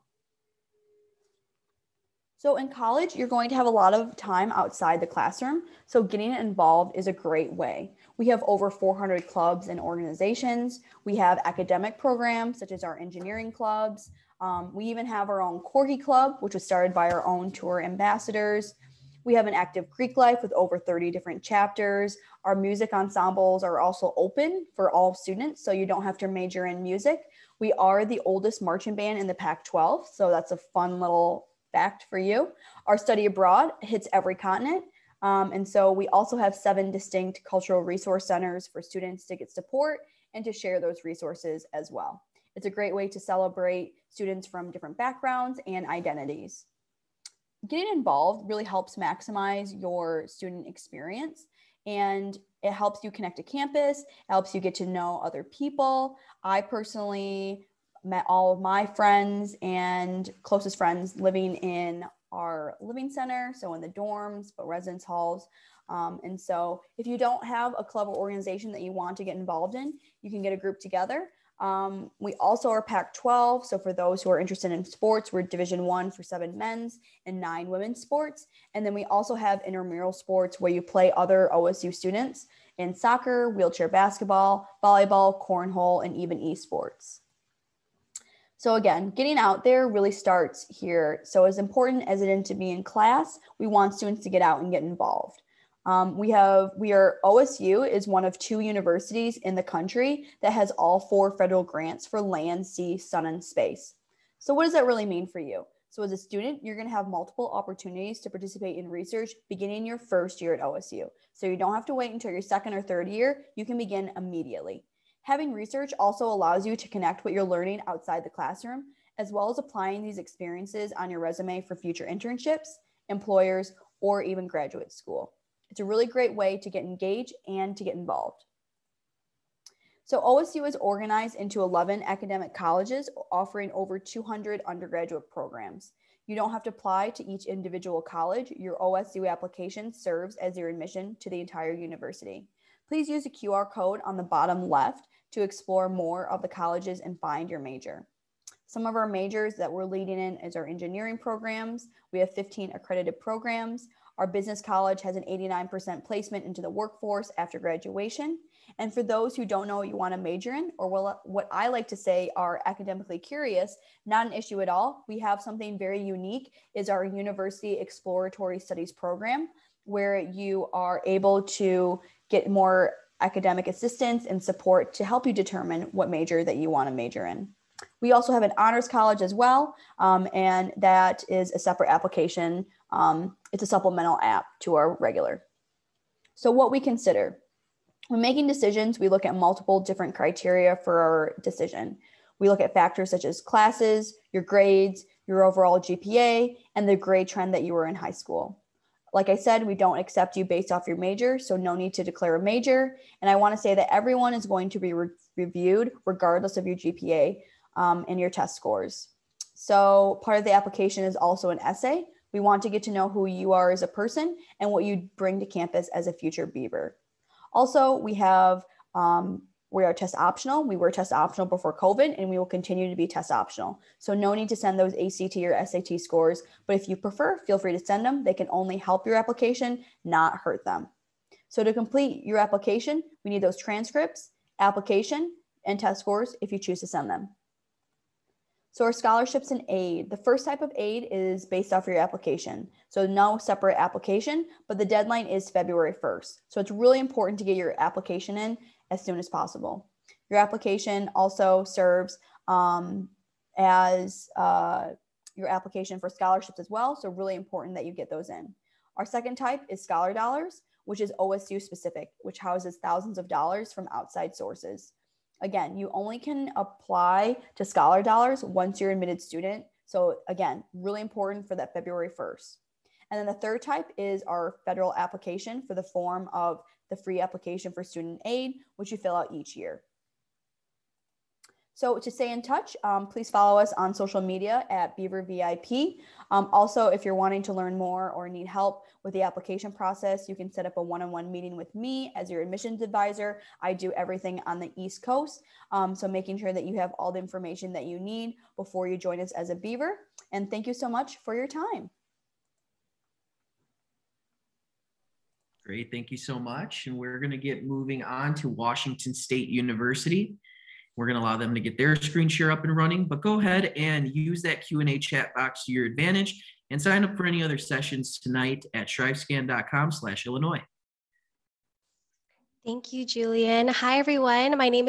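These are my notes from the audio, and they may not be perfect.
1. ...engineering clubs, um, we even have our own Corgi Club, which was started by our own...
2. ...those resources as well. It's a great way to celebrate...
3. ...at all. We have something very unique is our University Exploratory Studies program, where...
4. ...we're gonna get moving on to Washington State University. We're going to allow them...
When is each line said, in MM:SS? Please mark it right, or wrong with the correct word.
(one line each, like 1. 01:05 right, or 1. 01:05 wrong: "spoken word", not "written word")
1. 00:12 right
2. 00:40 right
3. 02:44 right
4. 05:06 right.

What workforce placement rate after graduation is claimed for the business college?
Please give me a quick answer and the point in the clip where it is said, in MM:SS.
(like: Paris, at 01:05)
89%, at 02:35.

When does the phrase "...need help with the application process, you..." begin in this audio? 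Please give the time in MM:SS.
04:48.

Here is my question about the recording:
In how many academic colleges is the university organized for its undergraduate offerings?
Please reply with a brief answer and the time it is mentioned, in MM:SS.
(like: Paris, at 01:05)
11, at 02:11.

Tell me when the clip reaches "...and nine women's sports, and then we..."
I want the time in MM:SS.
01:17.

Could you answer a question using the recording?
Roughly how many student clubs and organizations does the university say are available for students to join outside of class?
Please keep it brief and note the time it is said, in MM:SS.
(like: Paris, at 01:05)
over 400, at 00:08.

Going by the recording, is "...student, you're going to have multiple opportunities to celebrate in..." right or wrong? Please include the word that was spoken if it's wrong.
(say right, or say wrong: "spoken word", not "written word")
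wrong: "participate", not "celebrate".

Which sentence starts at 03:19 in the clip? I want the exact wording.
Like I said, we don't accept you based off your major, so no need to declare a major.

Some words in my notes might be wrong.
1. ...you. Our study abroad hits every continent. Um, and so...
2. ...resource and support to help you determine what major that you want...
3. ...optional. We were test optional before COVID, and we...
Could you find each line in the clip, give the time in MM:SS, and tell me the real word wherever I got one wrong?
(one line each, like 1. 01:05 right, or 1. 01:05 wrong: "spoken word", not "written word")
1. 00:32 right
2. 02:53 wrong: "assistance", not "resource"
3. 03:40 right.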